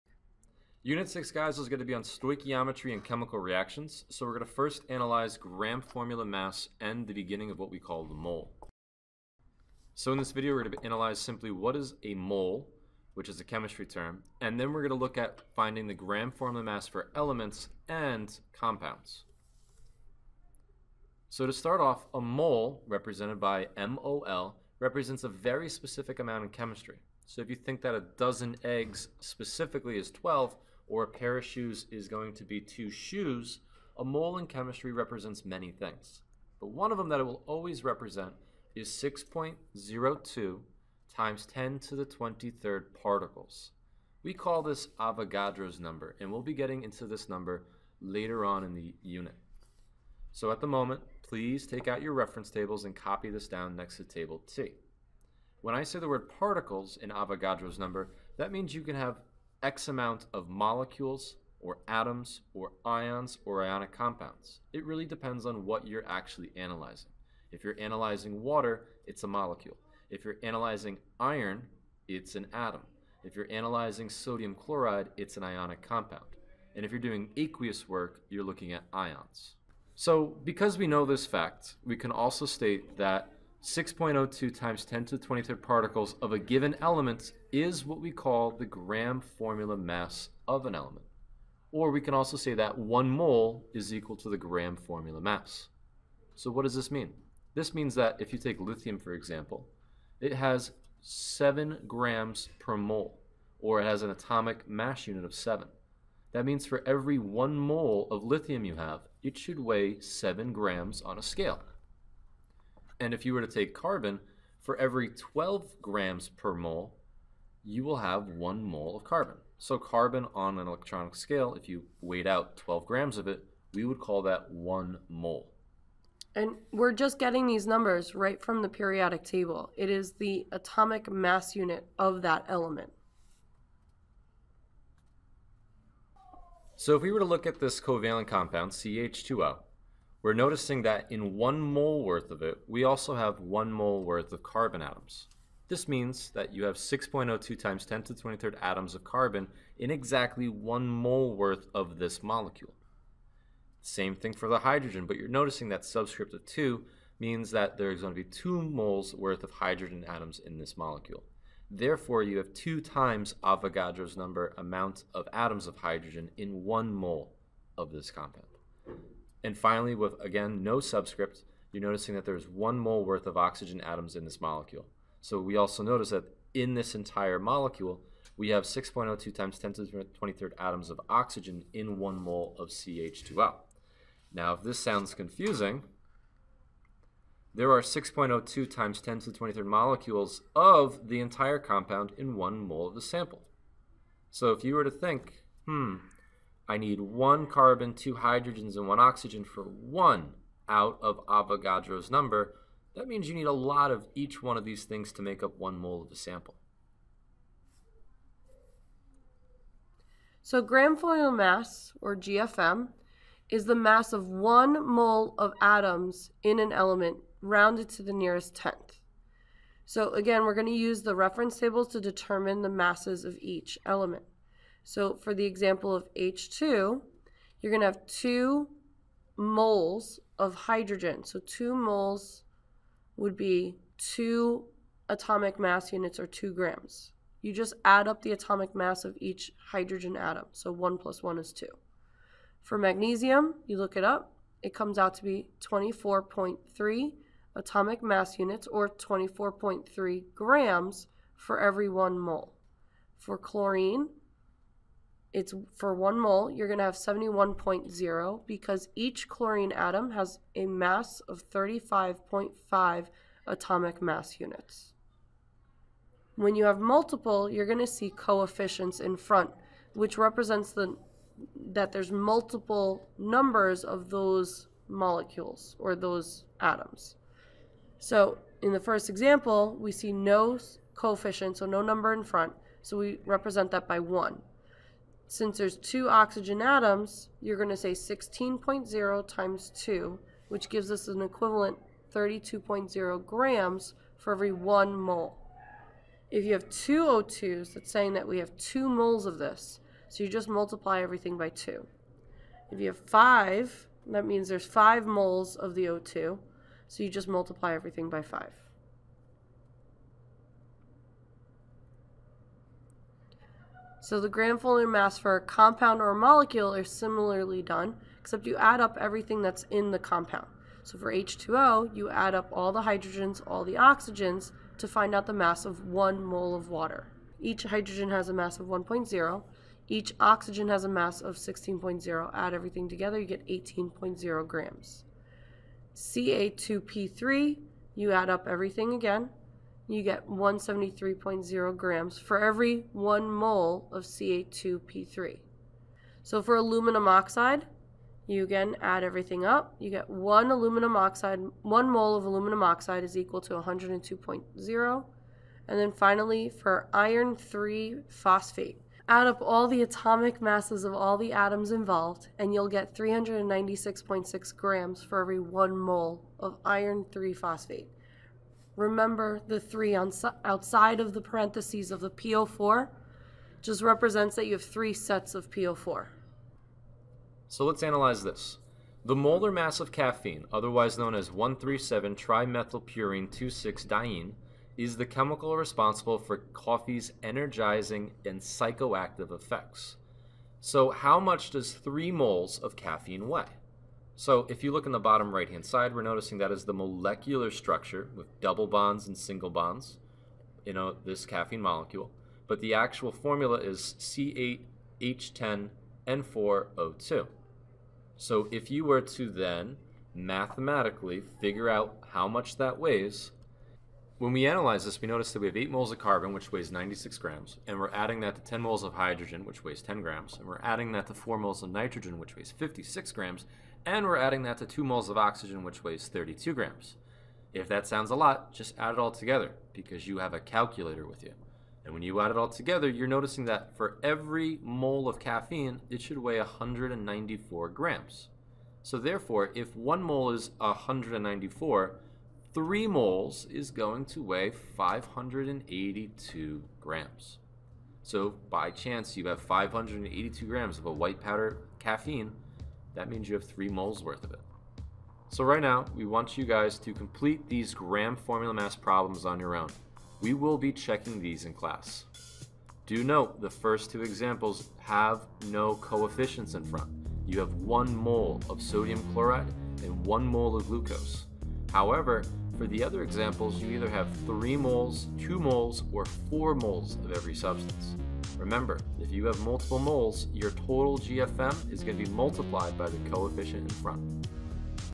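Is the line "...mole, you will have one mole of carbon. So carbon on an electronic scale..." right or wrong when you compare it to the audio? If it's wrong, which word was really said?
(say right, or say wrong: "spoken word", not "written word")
right.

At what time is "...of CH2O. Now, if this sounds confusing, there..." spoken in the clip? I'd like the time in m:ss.
3:02.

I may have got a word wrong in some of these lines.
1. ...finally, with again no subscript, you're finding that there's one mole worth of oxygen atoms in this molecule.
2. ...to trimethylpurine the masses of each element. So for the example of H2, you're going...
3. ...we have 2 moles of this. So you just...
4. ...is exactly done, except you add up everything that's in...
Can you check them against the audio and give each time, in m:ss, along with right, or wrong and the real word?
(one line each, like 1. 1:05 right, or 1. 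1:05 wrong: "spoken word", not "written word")
1. 2:49 wrong: "noticing", not "finding"
2. 3:41 wrong: "determine", not "trimethylpurine"
3. 4:58 right
4. 5:16 wrong: "similarly", not "exactly".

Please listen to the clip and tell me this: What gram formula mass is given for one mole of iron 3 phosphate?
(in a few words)
396.6 grams.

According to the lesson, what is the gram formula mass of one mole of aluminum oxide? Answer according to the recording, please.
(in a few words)
102.0.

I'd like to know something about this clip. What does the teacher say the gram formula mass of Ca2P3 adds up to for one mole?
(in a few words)
173.0 grams.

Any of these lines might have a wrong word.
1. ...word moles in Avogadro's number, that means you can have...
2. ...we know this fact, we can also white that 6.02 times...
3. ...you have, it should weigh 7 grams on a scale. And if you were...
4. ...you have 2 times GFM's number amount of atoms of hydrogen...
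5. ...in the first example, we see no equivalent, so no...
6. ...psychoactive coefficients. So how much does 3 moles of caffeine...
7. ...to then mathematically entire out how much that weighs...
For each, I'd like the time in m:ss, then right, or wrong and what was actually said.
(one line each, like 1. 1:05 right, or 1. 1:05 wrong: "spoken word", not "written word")
1. 0:56 wrong: "particles", not "moles"
2. 1:20 wrong: "state", not "white"
3. 1:48 right
4. 2:42 wrong: "Avogadro", not "GFM"
5. 4:38 wrong: "coefficient", not "equivalent"
6. 6:28 wrong: "effects", not "coefficients"
7. 6:49 wrong: "figure", not "entire".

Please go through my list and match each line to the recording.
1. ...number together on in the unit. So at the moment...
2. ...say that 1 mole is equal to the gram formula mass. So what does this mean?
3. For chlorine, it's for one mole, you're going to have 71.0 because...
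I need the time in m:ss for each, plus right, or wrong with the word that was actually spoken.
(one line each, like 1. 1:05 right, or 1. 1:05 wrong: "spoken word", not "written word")
1. 0:47 wrong: "later", not "together"
2. 1:32 right
3. 4:13 right.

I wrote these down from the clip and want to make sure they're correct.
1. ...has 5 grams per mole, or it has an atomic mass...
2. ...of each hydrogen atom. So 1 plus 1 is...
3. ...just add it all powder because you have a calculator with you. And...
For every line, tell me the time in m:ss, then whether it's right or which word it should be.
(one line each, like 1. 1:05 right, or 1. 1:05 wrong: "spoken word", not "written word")
1. 1:40 wrong: "7", not "5"
2. 3:59 right
3. 7:08 wrong: "together", not "powder".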